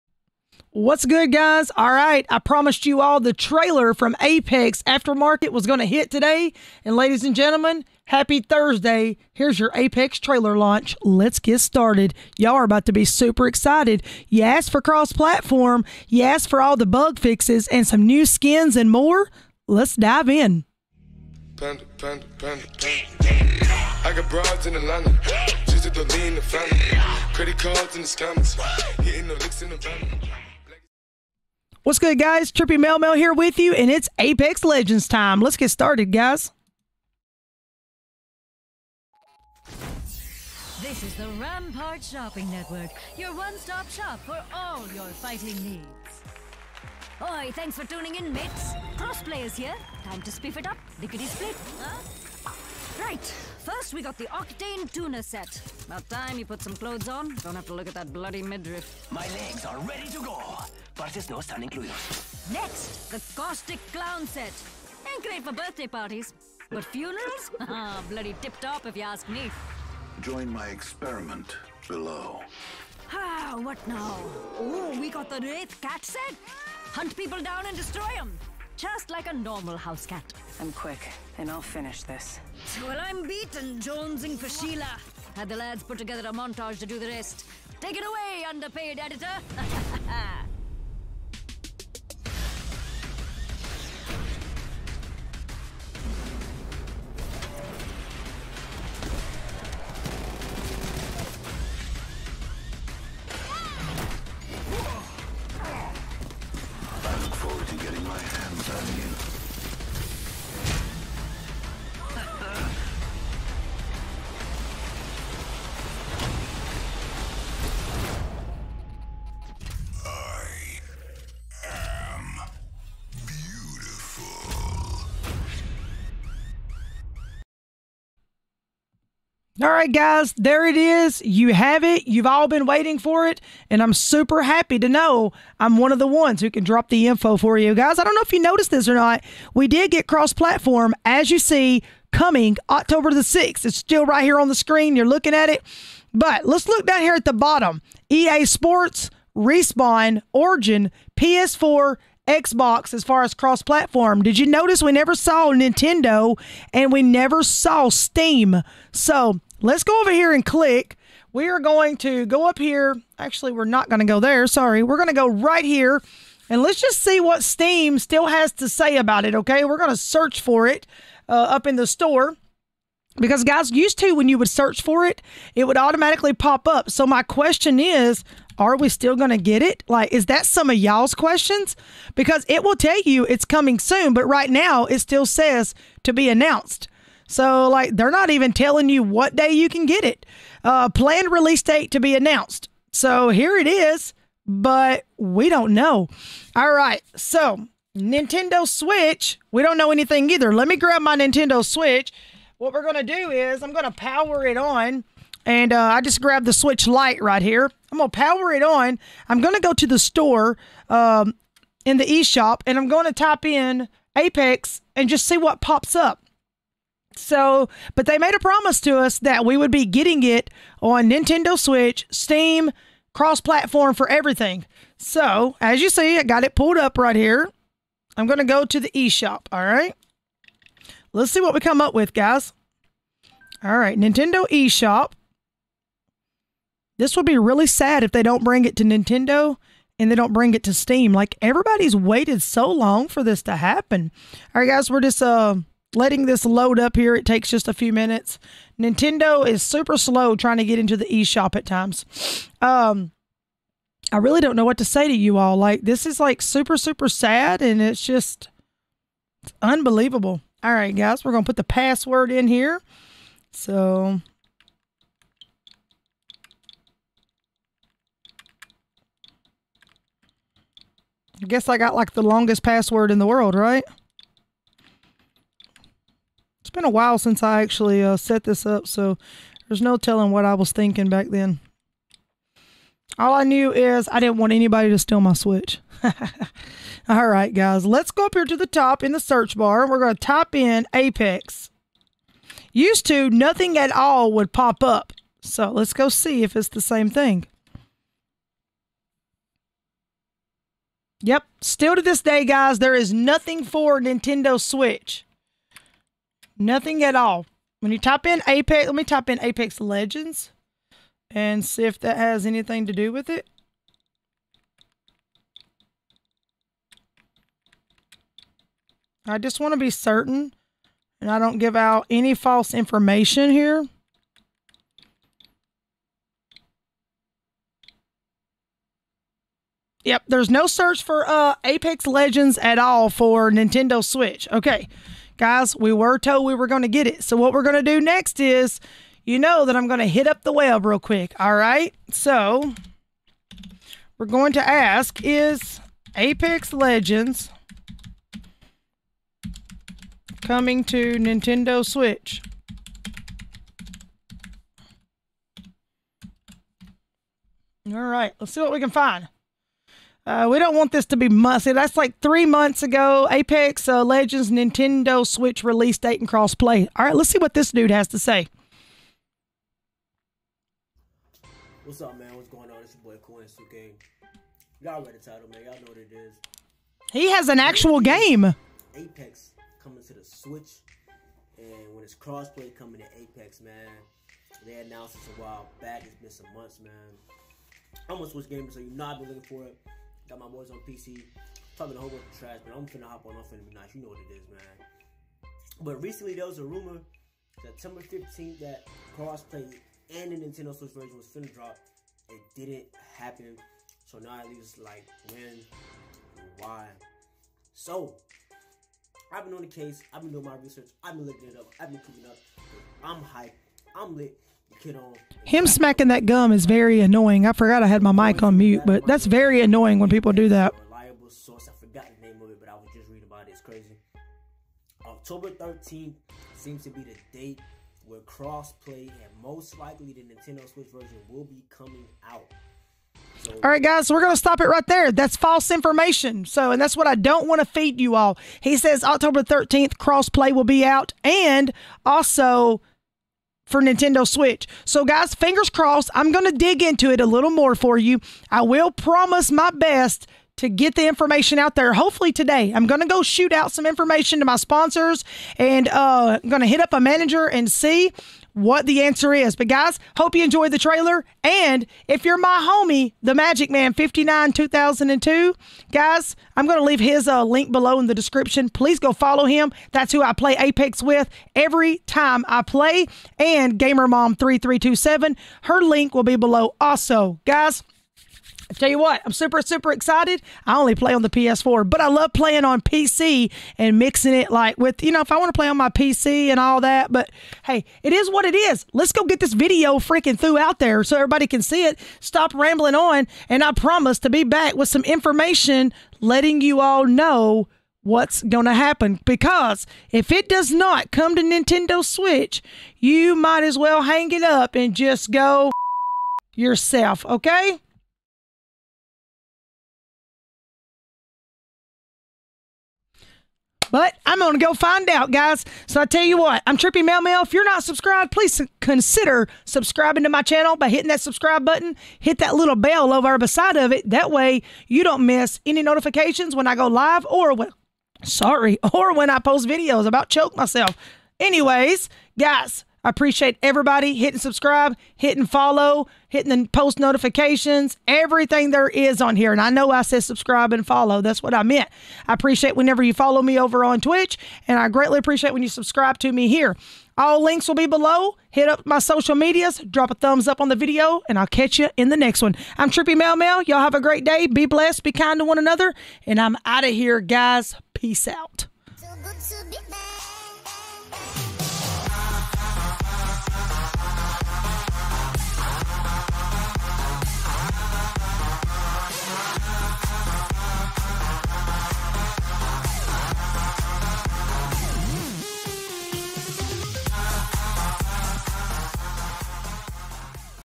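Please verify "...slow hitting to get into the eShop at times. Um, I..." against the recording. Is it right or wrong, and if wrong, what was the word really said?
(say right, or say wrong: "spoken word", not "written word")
wrong: "trying", not "hitting".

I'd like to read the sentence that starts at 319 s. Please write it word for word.
I just want to be certain and I don't give out any false information here.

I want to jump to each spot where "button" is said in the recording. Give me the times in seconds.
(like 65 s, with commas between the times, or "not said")
521 s.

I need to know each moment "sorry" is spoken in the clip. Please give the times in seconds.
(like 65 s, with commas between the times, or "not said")
164 s, 528 s.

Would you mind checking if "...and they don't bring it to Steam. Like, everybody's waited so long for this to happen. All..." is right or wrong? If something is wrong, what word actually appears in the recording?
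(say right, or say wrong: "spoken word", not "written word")
right.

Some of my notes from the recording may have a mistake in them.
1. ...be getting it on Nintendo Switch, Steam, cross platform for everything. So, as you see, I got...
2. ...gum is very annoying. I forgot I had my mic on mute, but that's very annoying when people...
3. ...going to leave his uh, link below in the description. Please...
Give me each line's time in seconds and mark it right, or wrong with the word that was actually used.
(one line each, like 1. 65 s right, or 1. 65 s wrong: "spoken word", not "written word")
1. 219 s right
2. 416 s right
3. 466 s right.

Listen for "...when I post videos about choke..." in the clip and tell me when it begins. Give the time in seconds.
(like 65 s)
529 s.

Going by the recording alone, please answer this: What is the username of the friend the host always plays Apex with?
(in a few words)
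Magic Man 59 2002.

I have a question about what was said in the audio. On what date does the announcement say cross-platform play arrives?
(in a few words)
October 6th.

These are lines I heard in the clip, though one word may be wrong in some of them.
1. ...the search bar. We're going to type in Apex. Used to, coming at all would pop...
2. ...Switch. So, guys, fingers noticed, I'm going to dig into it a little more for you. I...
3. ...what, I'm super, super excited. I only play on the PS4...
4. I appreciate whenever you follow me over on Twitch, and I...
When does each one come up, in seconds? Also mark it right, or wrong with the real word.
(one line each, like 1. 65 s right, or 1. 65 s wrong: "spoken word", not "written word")
1. 289 s wrong: "nothing", not "coming"
2. 444 s wrong: "crossed", not "noticed"
3. 478 s right
4. 542 s right.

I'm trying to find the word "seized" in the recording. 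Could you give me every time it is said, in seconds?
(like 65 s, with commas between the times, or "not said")
not said.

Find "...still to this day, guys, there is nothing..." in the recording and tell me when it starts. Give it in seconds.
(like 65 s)
301 s.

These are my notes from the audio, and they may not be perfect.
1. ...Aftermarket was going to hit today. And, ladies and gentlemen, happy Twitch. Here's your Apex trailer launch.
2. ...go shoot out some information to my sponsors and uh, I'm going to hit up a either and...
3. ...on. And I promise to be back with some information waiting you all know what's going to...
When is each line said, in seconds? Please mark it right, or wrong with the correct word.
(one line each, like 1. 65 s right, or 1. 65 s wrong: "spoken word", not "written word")
1. 4 s wrong: "Thursday", not "Twitch"
2. 453 s wrong: "manager", not "either"
3. 492 s wrong: "letting", not "waiting".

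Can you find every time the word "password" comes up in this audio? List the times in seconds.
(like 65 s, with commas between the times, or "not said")
261 s, 272 s.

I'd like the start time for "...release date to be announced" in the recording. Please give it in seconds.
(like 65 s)
191 s.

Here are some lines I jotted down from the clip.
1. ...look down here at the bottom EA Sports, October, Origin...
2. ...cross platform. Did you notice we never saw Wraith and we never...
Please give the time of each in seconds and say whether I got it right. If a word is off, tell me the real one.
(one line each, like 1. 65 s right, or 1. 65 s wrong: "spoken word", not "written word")
1. 146 s wrong: "Respawn", not "October"
2. 153 s wrong: "Nintendo", not "Wraith".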